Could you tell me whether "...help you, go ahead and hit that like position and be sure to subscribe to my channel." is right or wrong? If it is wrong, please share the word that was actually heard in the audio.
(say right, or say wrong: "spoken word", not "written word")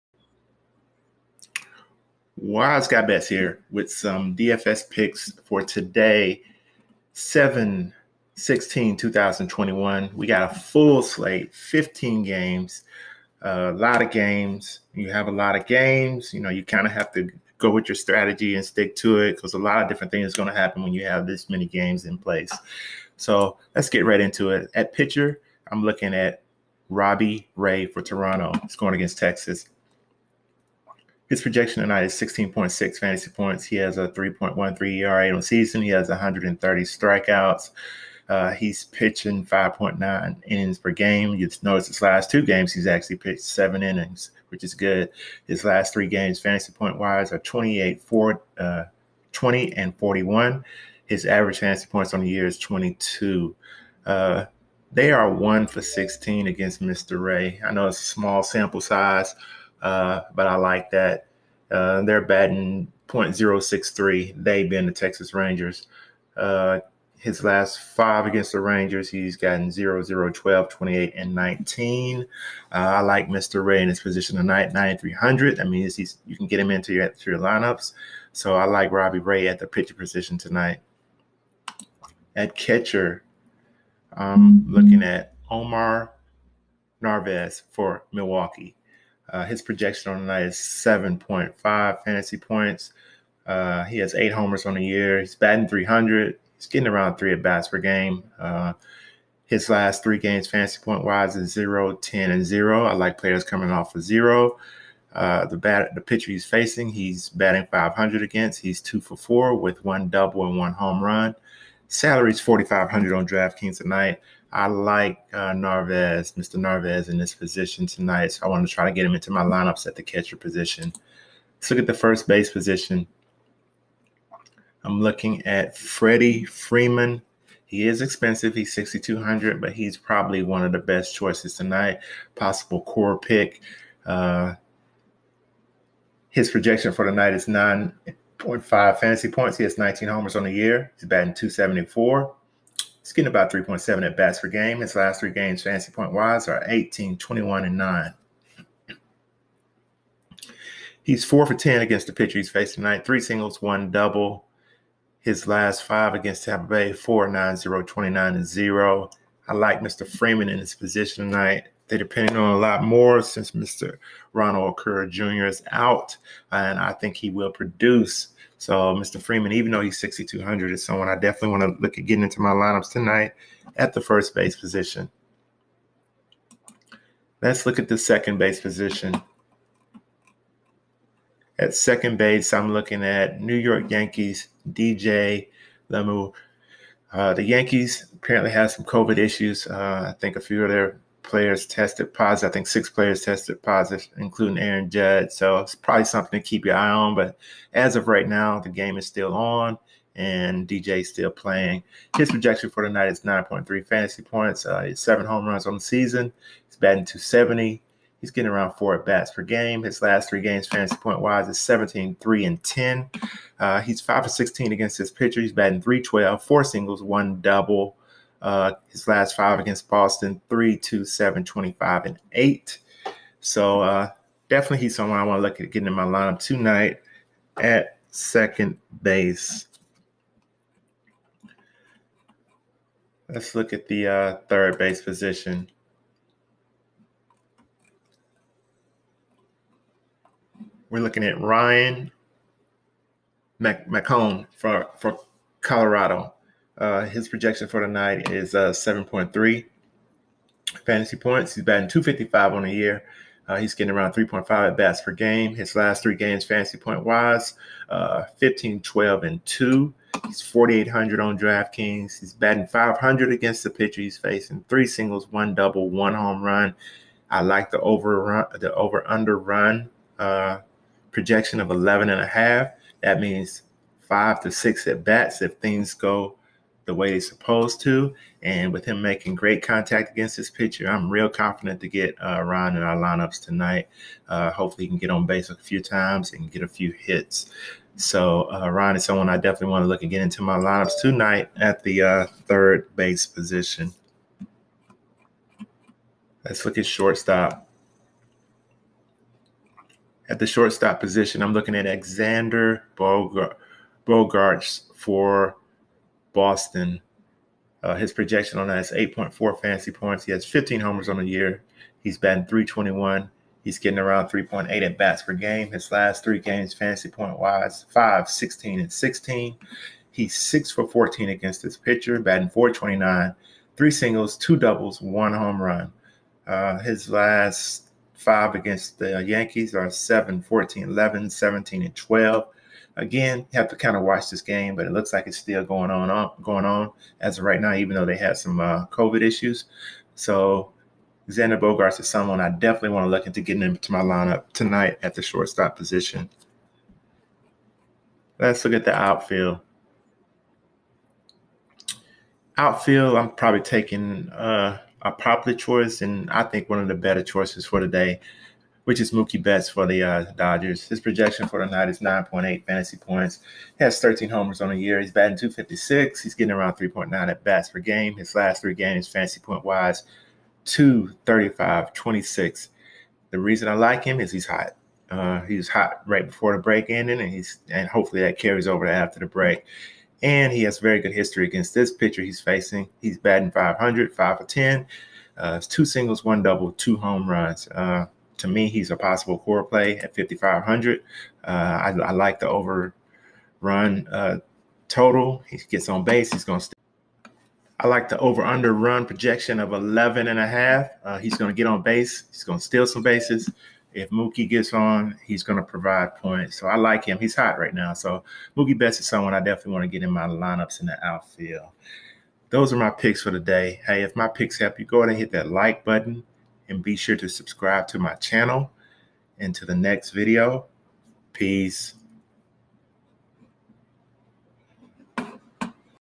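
wrong: "button", not "position".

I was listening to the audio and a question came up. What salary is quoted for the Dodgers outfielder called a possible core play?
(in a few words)
5,500.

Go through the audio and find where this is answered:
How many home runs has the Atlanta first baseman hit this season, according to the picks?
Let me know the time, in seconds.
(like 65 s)
139 s.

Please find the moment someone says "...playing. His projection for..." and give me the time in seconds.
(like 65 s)
201 s.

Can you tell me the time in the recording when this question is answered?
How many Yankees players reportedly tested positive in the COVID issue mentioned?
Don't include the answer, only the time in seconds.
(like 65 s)
192 s.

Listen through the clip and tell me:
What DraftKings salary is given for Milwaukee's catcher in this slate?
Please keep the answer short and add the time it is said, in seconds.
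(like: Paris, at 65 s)
4,500, at 112 s.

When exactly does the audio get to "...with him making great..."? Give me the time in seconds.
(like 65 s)
278 s.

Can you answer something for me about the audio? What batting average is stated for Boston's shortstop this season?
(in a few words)
.321.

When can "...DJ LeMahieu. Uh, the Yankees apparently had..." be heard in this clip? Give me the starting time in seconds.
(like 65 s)
184 s.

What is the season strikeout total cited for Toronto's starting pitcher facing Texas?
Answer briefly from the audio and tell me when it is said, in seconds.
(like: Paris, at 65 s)
130, at 36 s.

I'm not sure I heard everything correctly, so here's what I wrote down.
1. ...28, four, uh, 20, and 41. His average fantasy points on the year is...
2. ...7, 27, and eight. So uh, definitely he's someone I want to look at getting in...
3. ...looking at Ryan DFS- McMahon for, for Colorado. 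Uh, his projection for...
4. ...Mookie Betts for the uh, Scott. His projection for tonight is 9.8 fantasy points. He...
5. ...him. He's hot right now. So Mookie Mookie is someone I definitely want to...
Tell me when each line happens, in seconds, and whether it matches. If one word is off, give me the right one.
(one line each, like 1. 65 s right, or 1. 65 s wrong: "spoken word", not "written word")
1. 47 s right
2. 221 s wrong: "25", not "27"
3. 240 s wrong: "Mac", not "DFS"
4. 359 s wrong: "Dodgers", not "Scott"
5. 407 s wrong: "Betts", not "Mookie".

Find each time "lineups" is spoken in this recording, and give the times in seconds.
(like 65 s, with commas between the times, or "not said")
77 s, 119 s, 172 s, 226 s, 282 s, 290 s, 344 s, 410 s.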